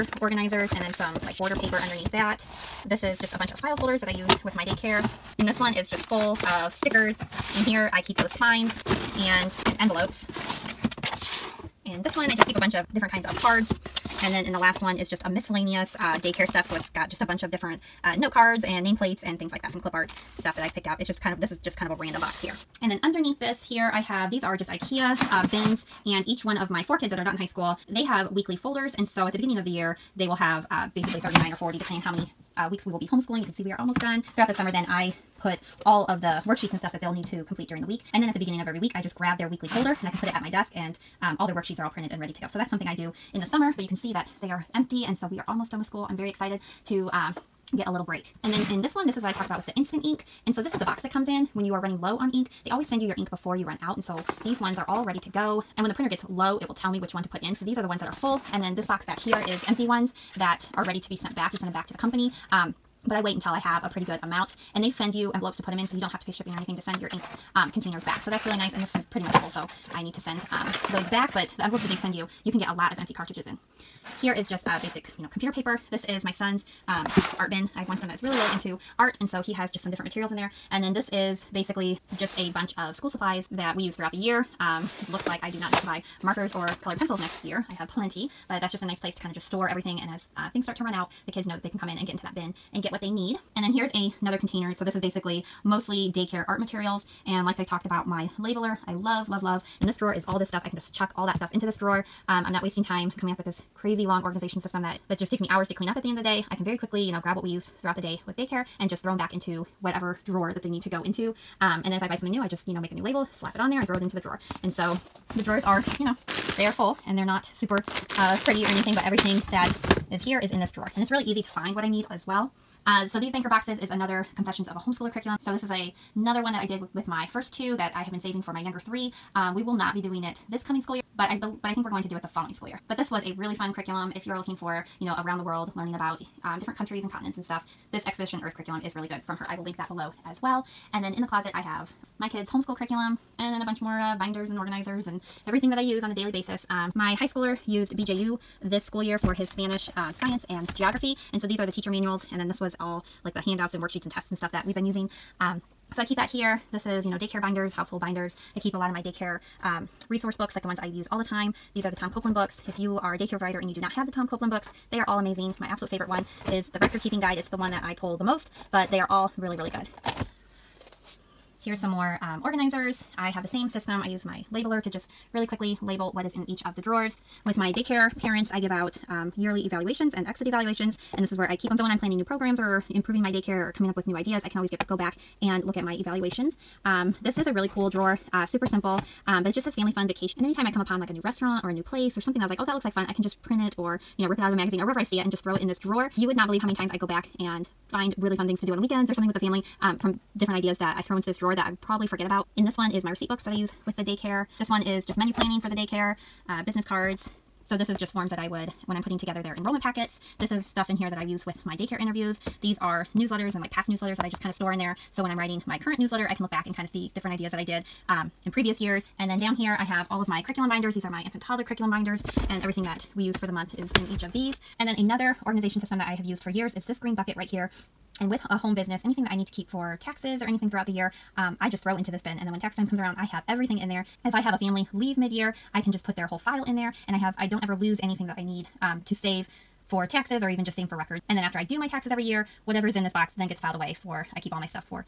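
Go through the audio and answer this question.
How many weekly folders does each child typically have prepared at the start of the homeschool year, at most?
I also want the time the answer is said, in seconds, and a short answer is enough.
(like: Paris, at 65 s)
40, at 31 s.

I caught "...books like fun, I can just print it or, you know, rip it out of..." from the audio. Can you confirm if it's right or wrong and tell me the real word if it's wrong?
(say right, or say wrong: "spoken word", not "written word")
wrong: "looks", not "books".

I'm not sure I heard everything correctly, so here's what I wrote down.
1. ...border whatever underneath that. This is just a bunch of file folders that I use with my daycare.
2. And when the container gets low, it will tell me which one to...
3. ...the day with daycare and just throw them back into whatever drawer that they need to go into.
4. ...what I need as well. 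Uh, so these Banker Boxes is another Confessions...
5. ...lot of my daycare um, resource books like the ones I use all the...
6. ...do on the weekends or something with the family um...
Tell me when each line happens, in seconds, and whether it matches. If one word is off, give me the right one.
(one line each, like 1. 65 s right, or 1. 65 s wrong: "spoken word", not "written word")
1. 1 s wrong: "paper", not "whatever"
2. 55 s wrong: "printer", not "container"
3. 107 s right
4. 121 s right
5. 158 s right
6. 198 s right.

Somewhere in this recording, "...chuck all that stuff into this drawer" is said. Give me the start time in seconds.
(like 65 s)
100 s.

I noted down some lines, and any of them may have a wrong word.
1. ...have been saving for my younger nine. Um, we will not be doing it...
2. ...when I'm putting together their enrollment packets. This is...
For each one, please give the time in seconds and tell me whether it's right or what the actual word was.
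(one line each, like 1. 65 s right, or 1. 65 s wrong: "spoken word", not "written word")
1. 128 s wrong: "three", not "nine"
2. 208 s right.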